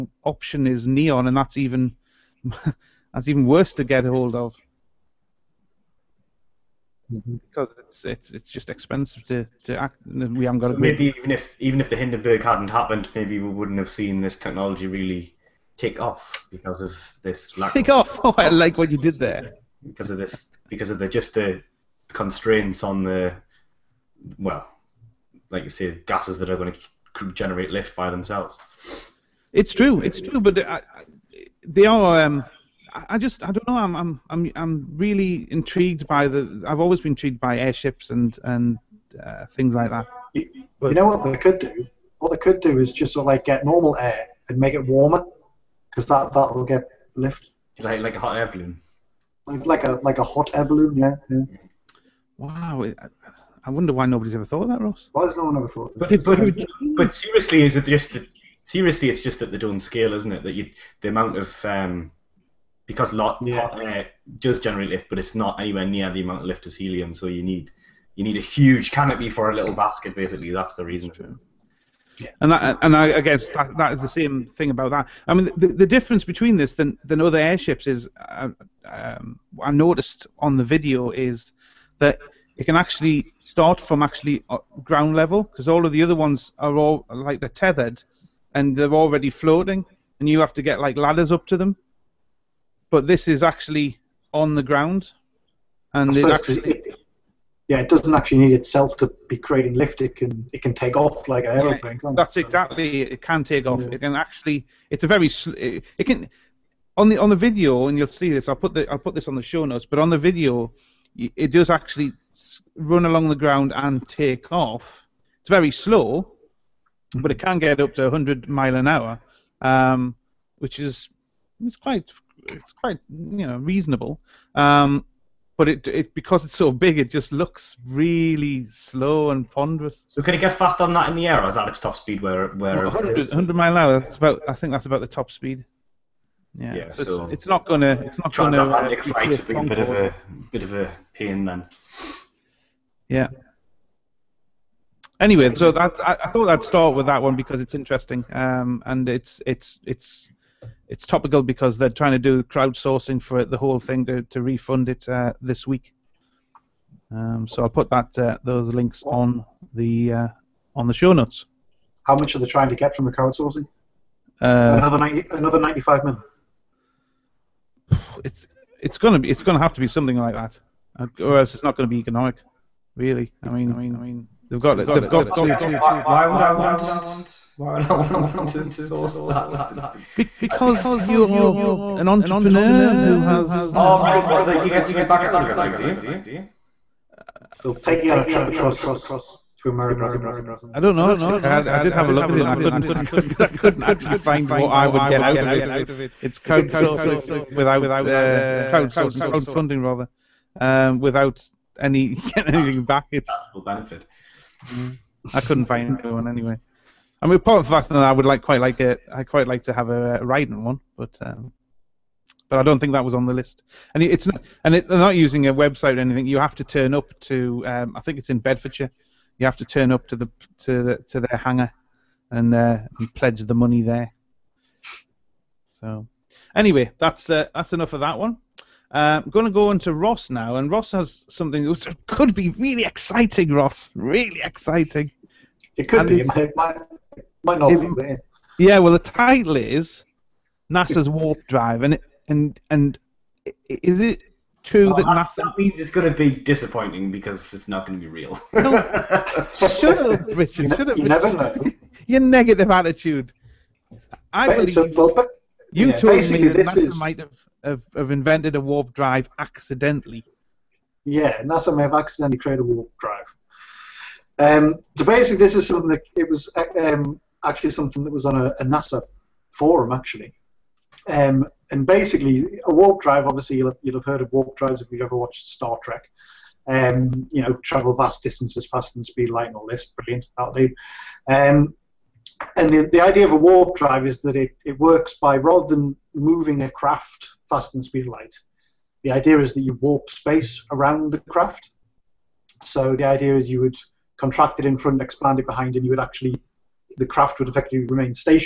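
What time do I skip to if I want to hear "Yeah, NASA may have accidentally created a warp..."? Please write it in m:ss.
4:21.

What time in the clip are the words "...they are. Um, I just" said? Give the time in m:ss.
0:31.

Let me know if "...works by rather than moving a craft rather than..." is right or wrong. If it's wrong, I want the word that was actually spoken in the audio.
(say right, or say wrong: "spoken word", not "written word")
wrong: "faster", not "rather".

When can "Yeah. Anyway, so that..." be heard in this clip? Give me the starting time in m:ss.
2:23.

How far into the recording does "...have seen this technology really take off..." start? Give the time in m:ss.
0:13.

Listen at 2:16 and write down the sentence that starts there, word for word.
Yeah, yeah so, it's, it's, not gonna it's not gonna.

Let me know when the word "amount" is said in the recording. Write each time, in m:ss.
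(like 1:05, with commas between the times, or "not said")
1:01, 1:06.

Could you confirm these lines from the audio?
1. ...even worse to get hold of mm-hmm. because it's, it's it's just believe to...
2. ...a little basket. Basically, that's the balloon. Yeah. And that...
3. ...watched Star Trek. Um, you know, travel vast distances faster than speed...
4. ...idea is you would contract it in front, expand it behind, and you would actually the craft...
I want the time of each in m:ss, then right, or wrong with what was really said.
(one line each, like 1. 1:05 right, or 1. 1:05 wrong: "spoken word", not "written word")
1. 0:03 wrong: "expensive", not "believe"
2. 1:09 wrong: "reason", not "balloon"
3. 4:35 right
4. 4:53 right.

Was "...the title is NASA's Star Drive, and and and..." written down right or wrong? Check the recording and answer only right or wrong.
wrong.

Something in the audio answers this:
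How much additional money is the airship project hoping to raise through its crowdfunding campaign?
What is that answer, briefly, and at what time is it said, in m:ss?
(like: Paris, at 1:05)
95 million, at 2:45.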